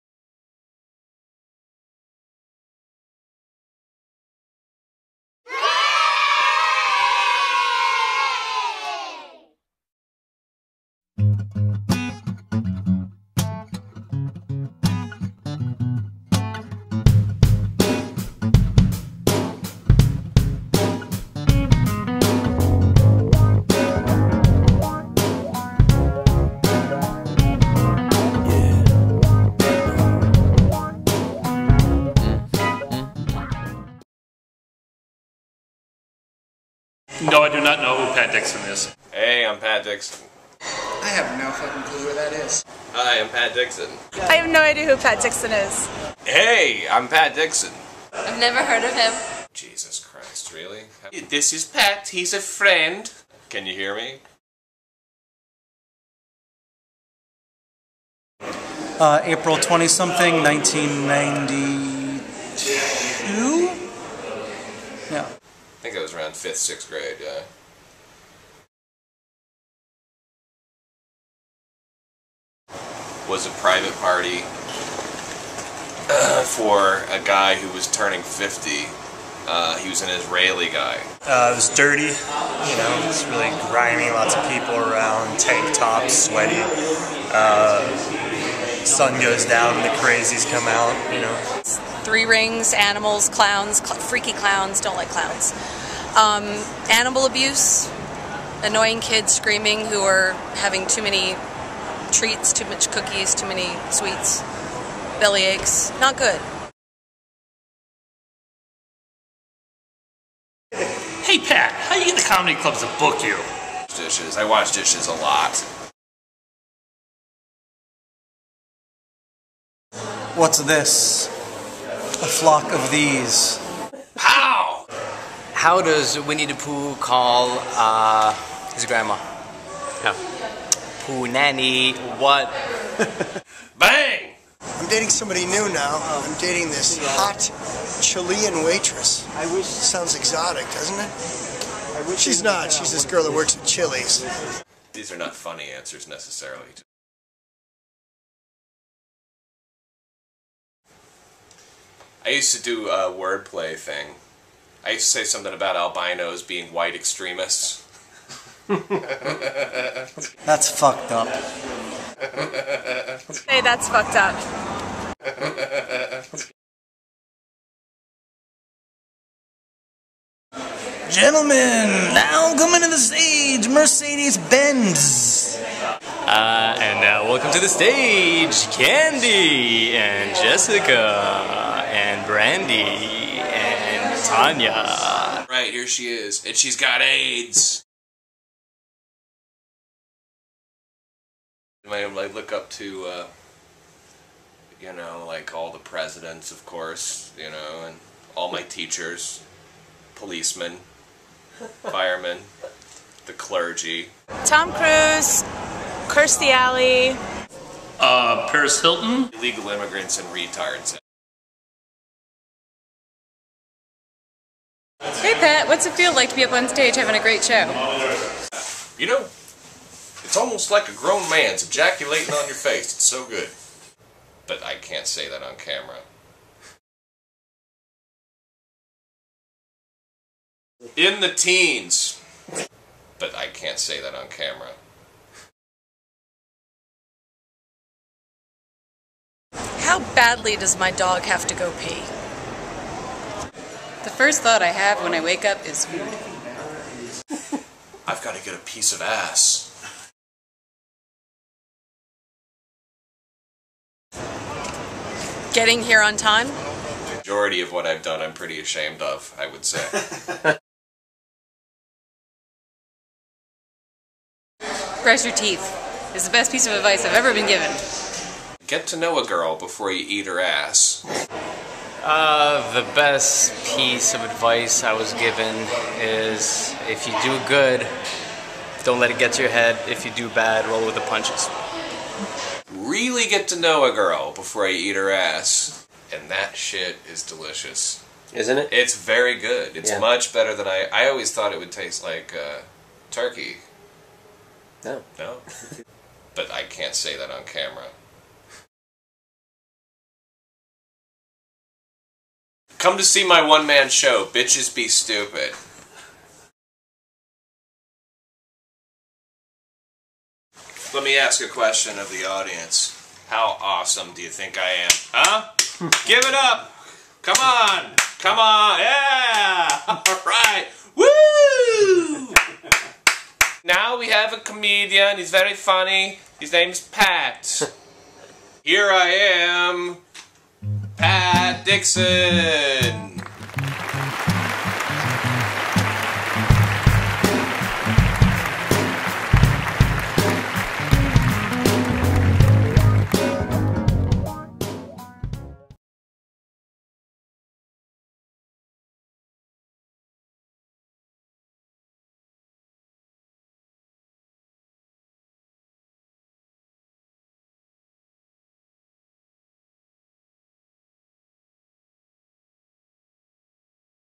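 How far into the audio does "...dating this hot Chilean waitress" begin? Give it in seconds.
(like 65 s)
136 s.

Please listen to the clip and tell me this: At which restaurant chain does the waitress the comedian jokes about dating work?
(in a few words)
Chili's.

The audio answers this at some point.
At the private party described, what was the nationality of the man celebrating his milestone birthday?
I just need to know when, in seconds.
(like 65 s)
80 s.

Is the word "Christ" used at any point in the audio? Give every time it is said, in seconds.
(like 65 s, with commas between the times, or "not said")
49 s.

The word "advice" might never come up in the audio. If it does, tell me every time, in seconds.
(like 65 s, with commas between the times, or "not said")
266 s, 274 s.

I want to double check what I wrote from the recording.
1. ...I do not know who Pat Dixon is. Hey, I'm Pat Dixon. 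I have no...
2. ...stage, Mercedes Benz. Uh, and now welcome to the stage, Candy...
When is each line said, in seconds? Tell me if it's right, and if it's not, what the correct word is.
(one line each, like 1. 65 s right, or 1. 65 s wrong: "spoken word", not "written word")
1. 37 s right
2. 172 s right.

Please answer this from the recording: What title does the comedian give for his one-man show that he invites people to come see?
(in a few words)
Bitches Be Stupid.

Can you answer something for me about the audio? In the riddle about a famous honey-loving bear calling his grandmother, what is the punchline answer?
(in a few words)
Who nanny.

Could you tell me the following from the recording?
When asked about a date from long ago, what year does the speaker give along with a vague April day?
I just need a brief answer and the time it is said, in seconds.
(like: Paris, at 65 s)
1992, at 60 s.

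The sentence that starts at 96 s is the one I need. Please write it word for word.
Um, animal abuse, annoying kids screaming who are having too many treats, too much cookies, too many sweets, belly aches.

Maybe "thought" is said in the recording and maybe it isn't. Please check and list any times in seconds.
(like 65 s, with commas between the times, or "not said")
244 s, 291 s.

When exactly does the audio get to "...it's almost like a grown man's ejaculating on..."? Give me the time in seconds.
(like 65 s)
220 s.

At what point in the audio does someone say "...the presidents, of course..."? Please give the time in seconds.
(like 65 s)
195 s.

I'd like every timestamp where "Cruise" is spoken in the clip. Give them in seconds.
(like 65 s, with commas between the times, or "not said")
204 s.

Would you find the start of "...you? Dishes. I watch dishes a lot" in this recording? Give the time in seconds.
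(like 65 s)
113 s.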